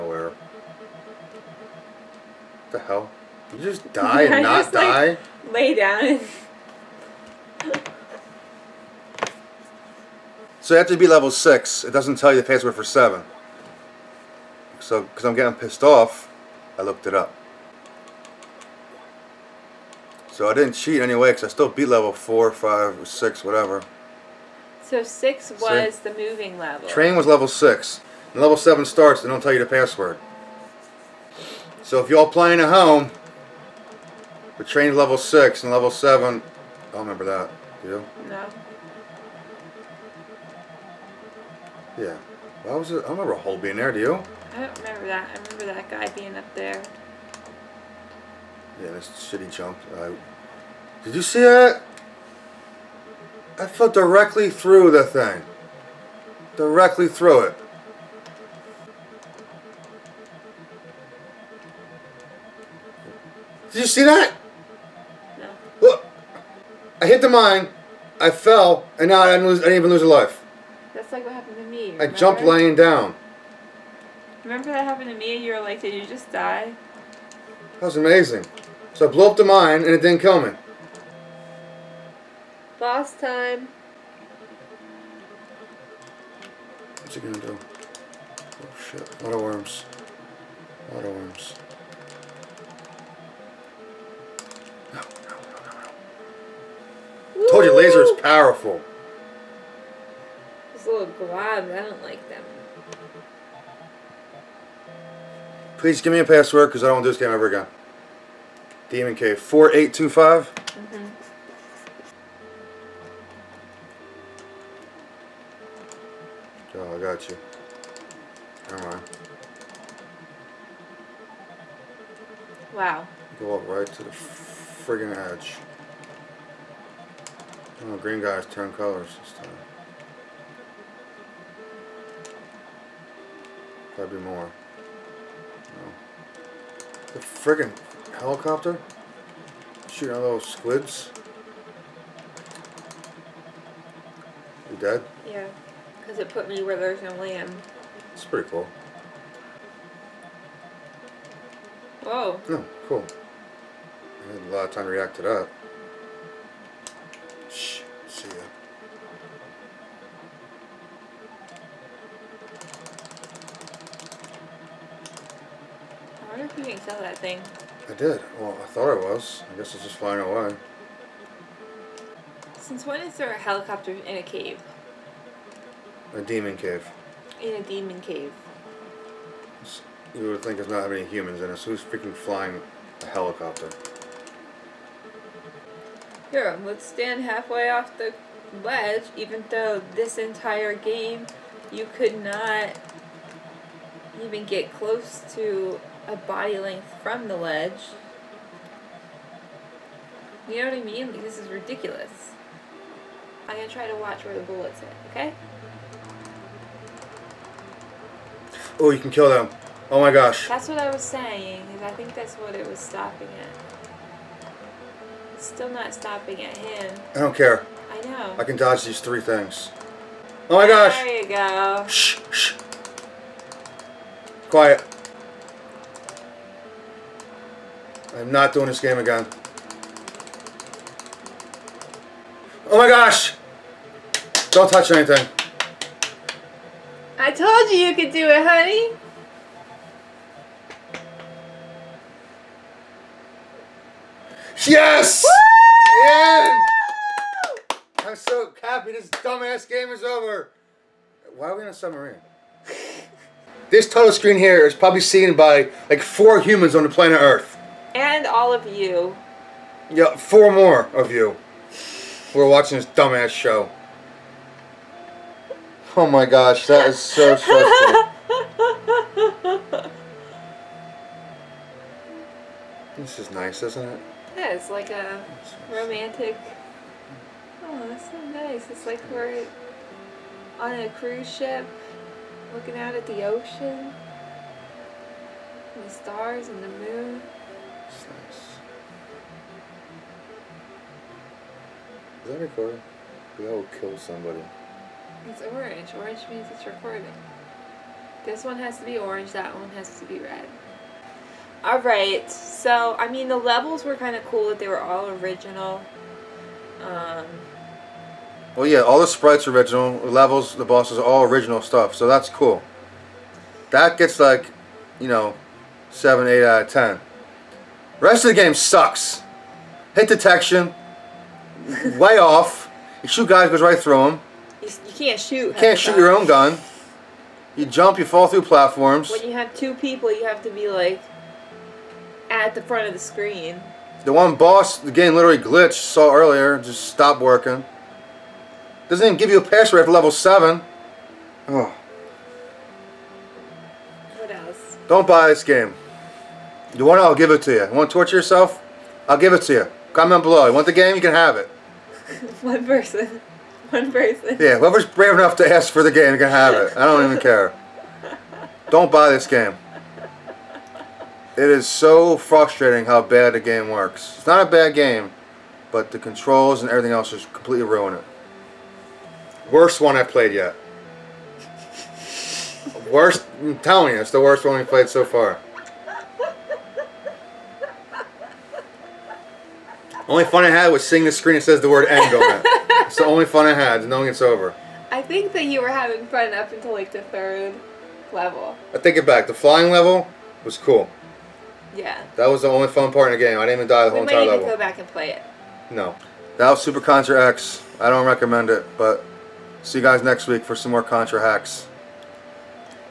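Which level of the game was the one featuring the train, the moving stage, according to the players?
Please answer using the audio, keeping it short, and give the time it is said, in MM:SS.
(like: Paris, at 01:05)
level 6, at 00:26.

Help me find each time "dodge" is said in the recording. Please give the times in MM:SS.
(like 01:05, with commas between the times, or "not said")
03:38.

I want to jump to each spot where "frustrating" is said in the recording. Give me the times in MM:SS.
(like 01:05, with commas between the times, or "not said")
06:02.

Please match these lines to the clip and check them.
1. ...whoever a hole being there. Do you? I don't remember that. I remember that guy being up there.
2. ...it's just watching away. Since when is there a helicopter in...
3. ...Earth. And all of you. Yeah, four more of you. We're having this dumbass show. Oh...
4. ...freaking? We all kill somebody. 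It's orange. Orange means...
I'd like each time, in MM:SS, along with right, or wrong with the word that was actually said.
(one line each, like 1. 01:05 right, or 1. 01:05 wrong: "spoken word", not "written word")
1. 00:43 wrong: "remember", not "whoever"
2. 02:49 wrong: "flying", not "watching"
3. 04:17 wrong: "watching", not "having"
4. 04:52 wrong: "recording", not "freaking".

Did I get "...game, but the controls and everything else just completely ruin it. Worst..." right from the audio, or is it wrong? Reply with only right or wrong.
right.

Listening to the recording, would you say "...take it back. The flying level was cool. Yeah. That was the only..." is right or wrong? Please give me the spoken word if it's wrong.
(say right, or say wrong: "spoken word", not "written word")
right.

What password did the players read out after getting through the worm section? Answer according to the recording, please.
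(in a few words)
Demon K 4825.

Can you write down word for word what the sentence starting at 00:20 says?
So I didn't cheat anyway, because I still beat level 4, 5, 6, whatever.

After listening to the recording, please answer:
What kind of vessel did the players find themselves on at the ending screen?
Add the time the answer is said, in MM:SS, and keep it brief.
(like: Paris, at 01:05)
submarine, at 04:11.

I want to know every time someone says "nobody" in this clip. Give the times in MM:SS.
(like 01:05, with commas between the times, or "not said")
not said.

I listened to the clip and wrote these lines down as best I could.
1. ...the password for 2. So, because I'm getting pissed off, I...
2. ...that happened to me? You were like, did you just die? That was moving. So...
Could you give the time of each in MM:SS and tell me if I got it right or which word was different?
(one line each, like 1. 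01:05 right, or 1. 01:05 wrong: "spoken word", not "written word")
1. 00:12 wrong: "7", not "2"
2. 01:14 wrong: "amazing", not "moving".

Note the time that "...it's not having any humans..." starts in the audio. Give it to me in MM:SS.
03:00.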